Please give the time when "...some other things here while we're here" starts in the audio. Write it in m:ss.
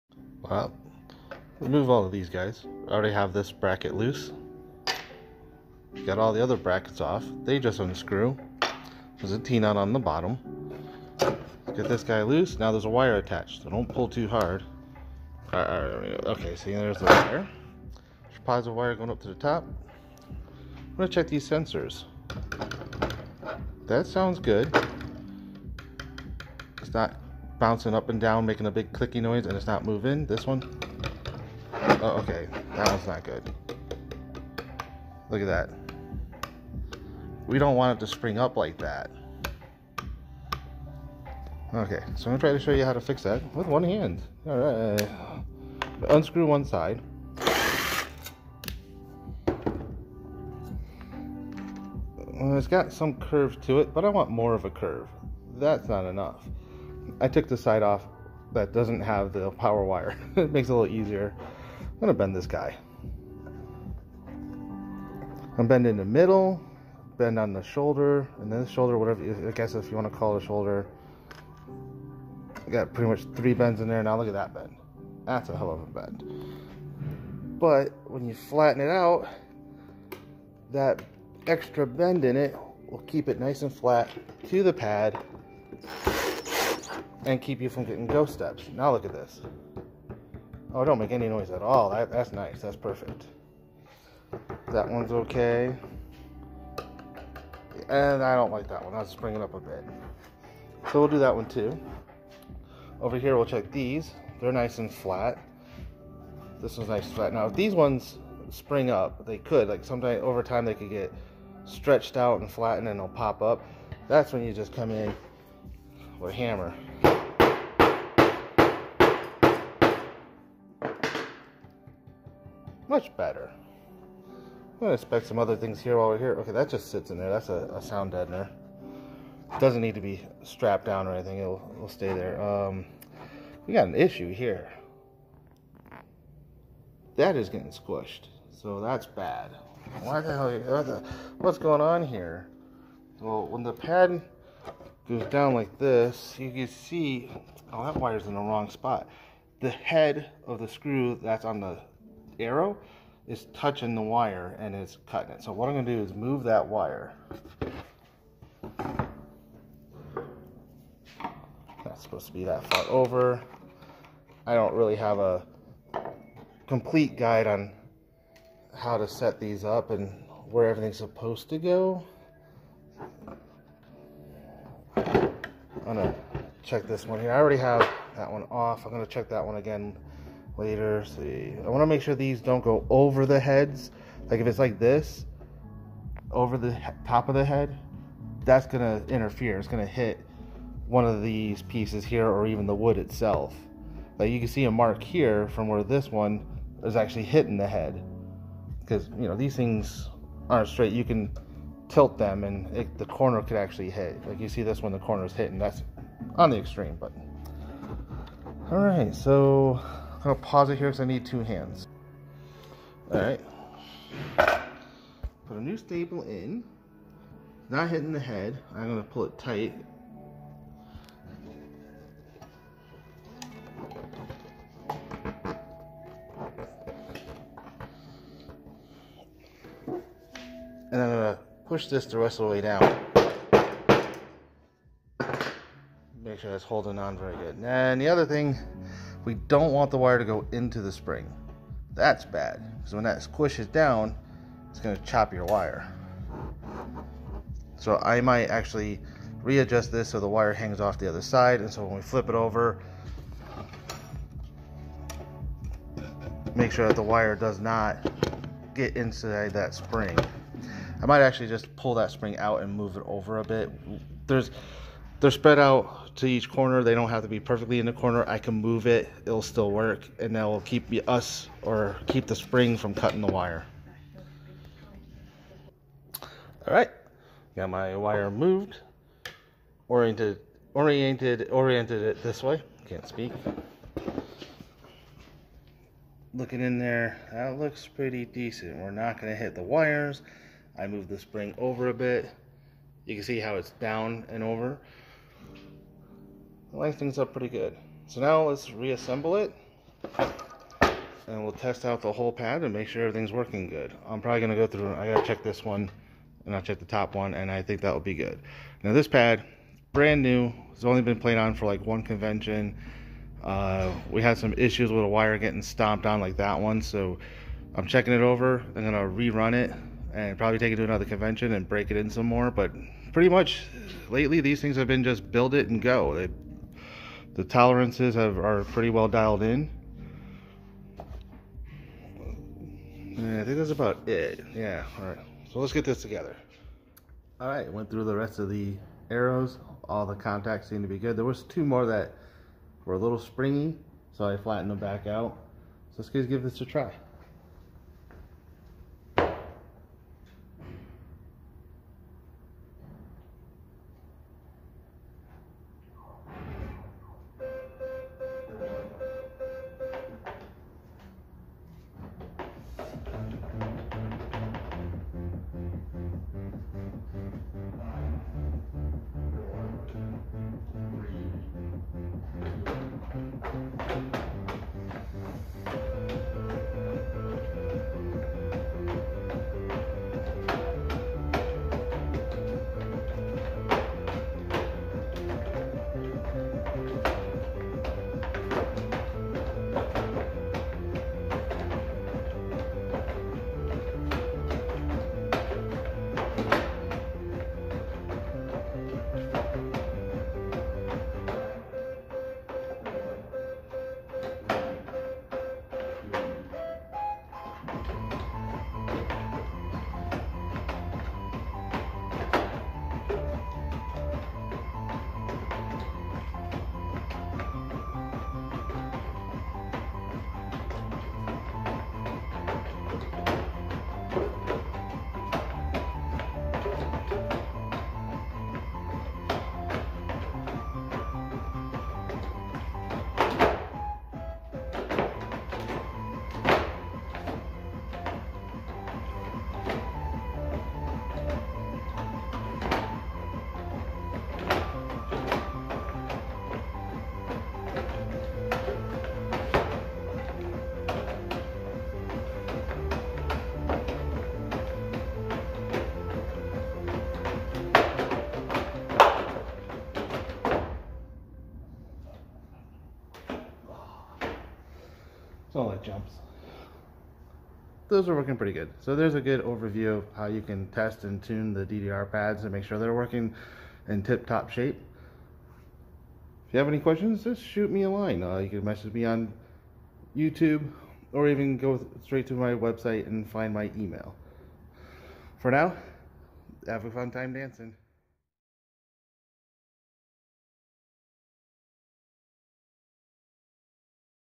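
2:05.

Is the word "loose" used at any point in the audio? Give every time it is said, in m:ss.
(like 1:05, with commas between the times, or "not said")
0:03, 0:12.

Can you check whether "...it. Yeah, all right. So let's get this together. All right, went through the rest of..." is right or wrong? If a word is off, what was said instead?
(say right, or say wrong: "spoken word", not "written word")
right.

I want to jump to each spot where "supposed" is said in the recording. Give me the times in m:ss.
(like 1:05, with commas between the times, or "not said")
2:42, 2:50.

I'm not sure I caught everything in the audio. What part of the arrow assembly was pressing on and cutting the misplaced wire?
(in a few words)
Head of the screw.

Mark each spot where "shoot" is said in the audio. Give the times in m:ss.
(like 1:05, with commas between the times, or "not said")
7:57.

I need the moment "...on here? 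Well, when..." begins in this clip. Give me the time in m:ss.
2:21.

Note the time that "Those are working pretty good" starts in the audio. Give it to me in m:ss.
7:47.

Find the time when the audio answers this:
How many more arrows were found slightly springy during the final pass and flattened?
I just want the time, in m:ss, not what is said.
5:41.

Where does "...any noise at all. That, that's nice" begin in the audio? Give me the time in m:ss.
1:31.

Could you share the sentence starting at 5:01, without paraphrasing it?
And we'll test out the whole pad and make sure everything's working good.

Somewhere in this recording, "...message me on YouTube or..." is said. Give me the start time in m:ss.
7:58.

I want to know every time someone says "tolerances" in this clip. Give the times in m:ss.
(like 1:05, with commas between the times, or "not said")
5:27.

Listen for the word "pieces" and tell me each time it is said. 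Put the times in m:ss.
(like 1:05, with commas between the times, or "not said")
3:11.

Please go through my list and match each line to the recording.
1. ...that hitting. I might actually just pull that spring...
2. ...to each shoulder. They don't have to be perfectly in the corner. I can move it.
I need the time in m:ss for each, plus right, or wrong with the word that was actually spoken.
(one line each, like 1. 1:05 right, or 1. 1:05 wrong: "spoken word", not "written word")
1. 4:19 wrong: "spring", not "hitting"
2. 4:26 wrong: "corner", not "shoulder".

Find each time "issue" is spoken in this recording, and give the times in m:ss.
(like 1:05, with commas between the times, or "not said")
2:13, 5:14.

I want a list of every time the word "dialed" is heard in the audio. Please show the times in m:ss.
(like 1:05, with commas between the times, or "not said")
5:29.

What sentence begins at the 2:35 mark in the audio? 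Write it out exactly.
So what I'm gonna do is move that wire.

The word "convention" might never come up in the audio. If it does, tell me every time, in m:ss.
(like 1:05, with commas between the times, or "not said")
5:12, 5:21.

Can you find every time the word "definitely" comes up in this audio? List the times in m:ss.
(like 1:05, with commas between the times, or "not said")
not said.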